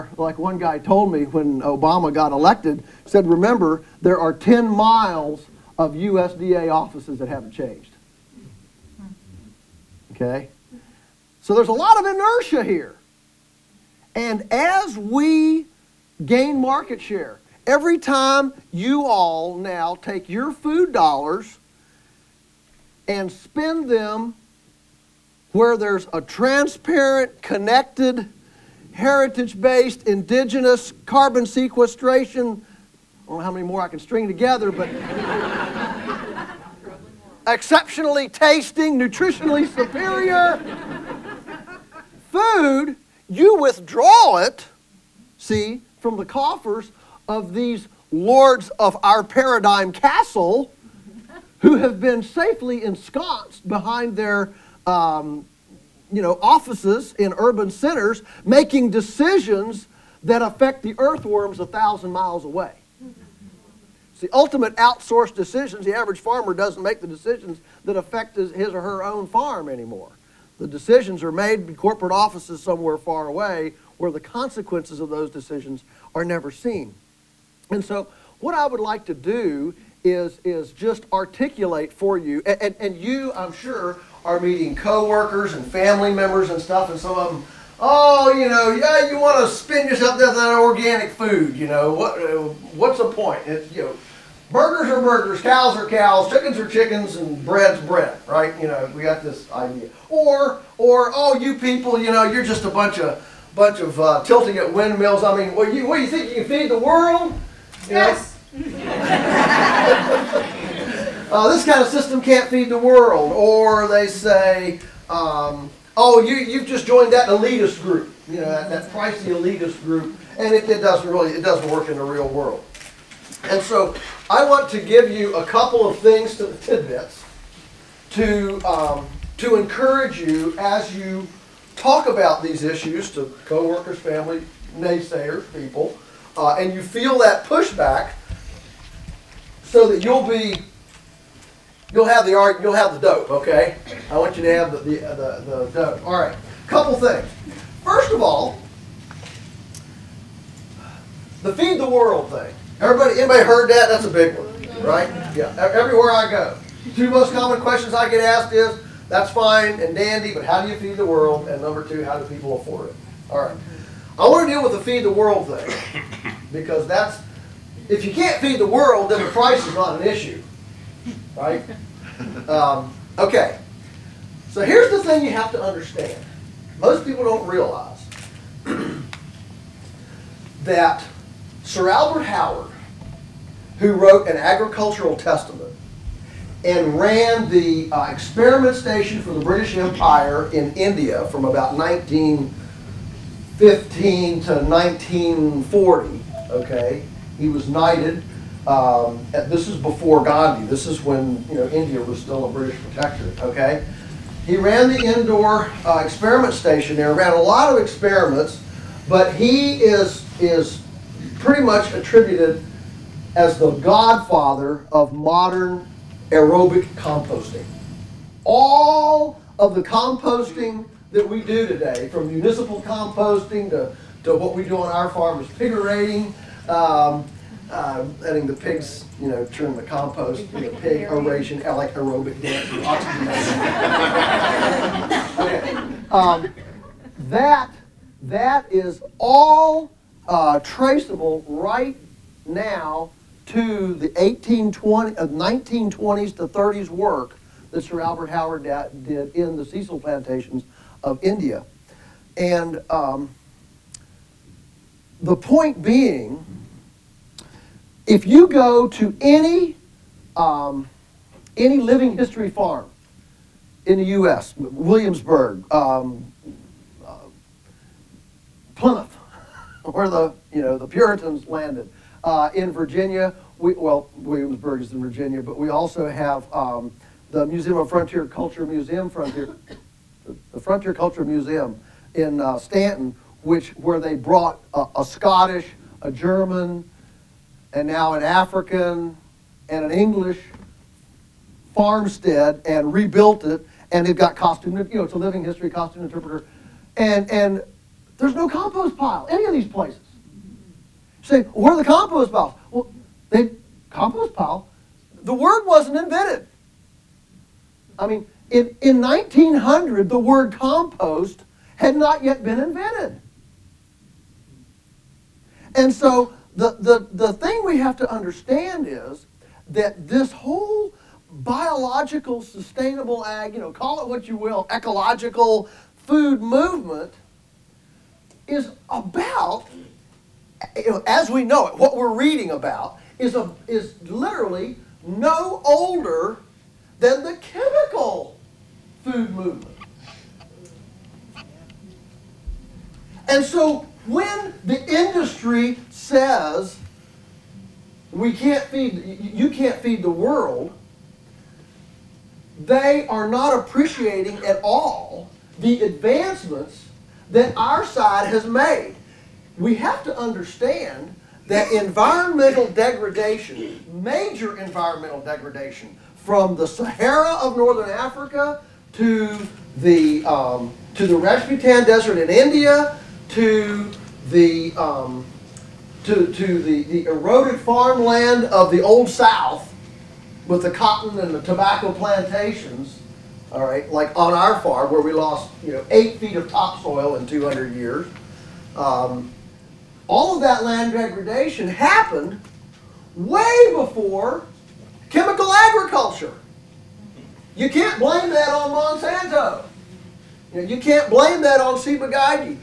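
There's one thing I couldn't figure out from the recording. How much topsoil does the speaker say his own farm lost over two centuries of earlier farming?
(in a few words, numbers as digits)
8 feet.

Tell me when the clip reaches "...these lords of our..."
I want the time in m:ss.
0:47.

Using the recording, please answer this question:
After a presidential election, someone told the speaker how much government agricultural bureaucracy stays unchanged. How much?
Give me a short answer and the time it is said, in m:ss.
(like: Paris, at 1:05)
10 miles, at 0:04.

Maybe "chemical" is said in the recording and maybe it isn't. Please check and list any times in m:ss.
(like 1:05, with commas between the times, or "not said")
5:37, 6:35.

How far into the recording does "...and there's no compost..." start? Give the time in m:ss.
4:57.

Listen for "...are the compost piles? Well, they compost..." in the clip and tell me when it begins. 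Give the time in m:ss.
5:01.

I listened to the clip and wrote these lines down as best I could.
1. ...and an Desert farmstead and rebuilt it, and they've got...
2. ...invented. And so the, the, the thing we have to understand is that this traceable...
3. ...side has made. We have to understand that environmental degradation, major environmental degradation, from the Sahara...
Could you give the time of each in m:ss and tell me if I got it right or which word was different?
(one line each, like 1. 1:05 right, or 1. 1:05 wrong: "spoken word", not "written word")
1. 4:49 wrong: "English", not "Desert"
2. 5:12 wrong: "whole", not "traceable"
3. 5:57 right.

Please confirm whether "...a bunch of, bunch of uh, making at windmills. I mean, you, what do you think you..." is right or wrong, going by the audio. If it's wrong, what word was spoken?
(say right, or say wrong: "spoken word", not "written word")
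wrong: "tilting", not "making".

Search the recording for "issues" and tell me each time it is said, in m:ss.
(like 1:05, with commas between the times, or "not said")
2:12, 2:50.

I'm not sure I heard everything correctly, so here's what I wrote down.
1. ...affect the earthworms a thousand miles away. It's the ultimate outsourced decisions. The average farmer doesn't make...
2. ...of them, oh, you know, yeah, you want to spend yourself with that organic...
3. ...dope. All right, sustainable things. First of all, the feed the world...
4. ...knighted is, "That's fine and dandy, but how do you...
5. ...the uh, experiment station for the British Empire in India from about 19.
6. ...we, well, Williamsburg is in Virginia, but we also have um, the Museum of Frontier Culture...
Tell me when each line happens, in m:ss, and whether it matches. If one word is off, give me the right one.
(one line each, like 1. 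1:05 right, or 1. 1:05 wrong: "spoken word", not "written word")
1. 1:00 right
2. 1:27 right
3. 2:25 wrong: "couple", not "sustainable"
4. 2:38 wrong: "asked", not "knighted"
5. 3:07 right
6. 4:33 right.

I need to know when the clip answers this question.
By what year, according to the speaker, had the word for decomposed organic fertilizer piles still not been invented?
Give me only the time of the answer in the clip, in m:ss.
5:09.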